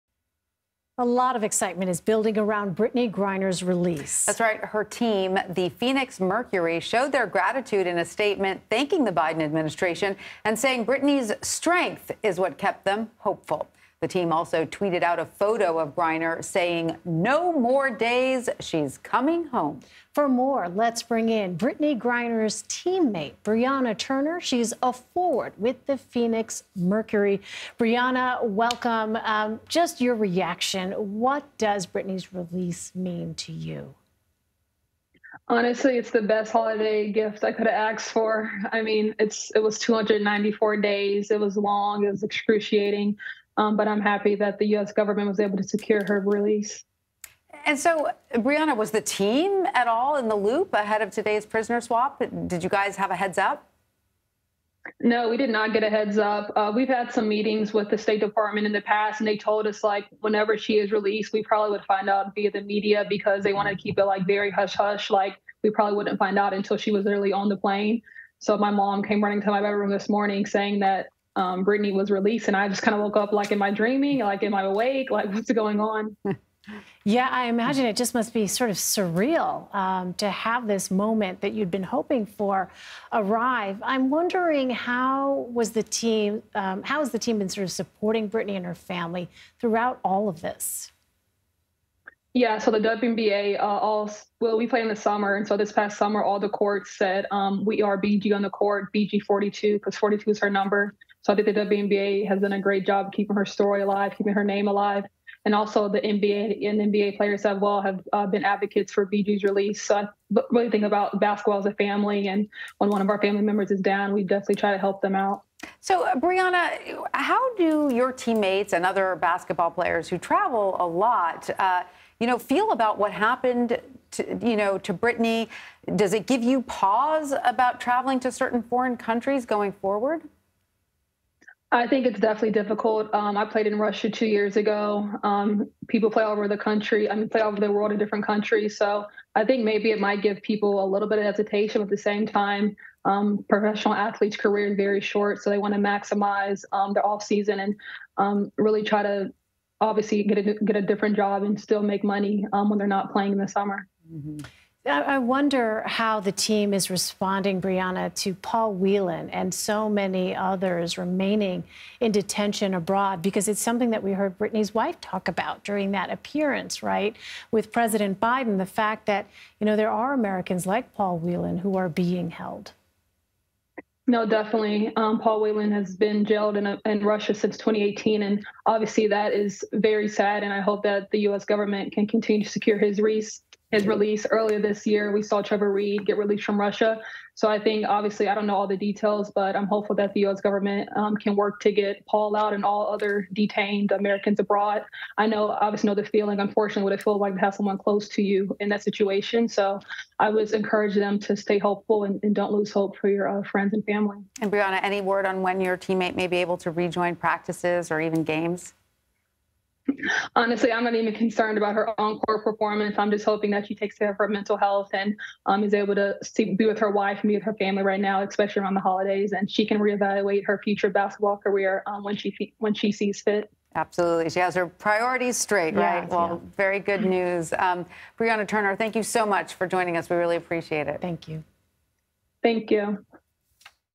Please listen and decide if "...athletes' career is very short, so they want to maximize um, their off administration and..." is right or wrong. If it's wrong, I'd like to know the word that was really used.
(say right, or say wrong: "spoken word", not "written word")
wrong: "season", not "administration".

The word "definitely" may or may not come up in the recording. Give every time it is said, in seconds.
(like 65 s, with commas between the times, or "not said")
114 s, 132 s, 174 s.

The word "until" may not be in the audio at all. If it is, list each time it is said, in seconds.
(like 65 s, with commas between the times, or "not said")
66 s.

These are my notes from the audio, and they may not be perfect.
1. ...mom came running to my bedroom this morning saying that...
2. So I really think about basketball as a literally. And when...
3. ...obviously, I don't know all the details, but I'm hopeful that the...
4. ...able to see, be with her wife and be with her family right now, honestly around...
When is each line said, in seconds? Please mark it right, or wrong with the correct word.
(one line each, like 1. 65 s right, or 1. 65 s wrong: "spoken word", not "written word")
1. 68 s right
2. 109 s wrong: "family", not "literally"
3. 187 s right
4. 215 s wrong: "especially", not "honestly".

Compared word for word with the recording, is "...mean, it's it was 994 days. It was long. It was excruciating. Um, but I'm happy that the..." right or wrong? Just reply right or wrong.
wrong.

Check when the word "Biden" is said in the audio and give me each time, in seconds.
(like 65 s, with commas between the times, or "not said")
9 s, 168 s.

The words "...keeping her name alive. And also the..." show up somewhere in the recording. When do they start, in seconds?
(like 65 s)
104 s.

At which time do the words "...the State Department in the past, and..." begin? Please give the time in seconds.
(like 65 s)
57 s.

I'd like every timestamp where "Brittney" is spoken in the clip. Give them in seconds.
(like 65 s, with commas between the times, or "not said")
2 s, 10 s, 21 s, 31 s, 71 s, 88 s, 124 s, 164 s.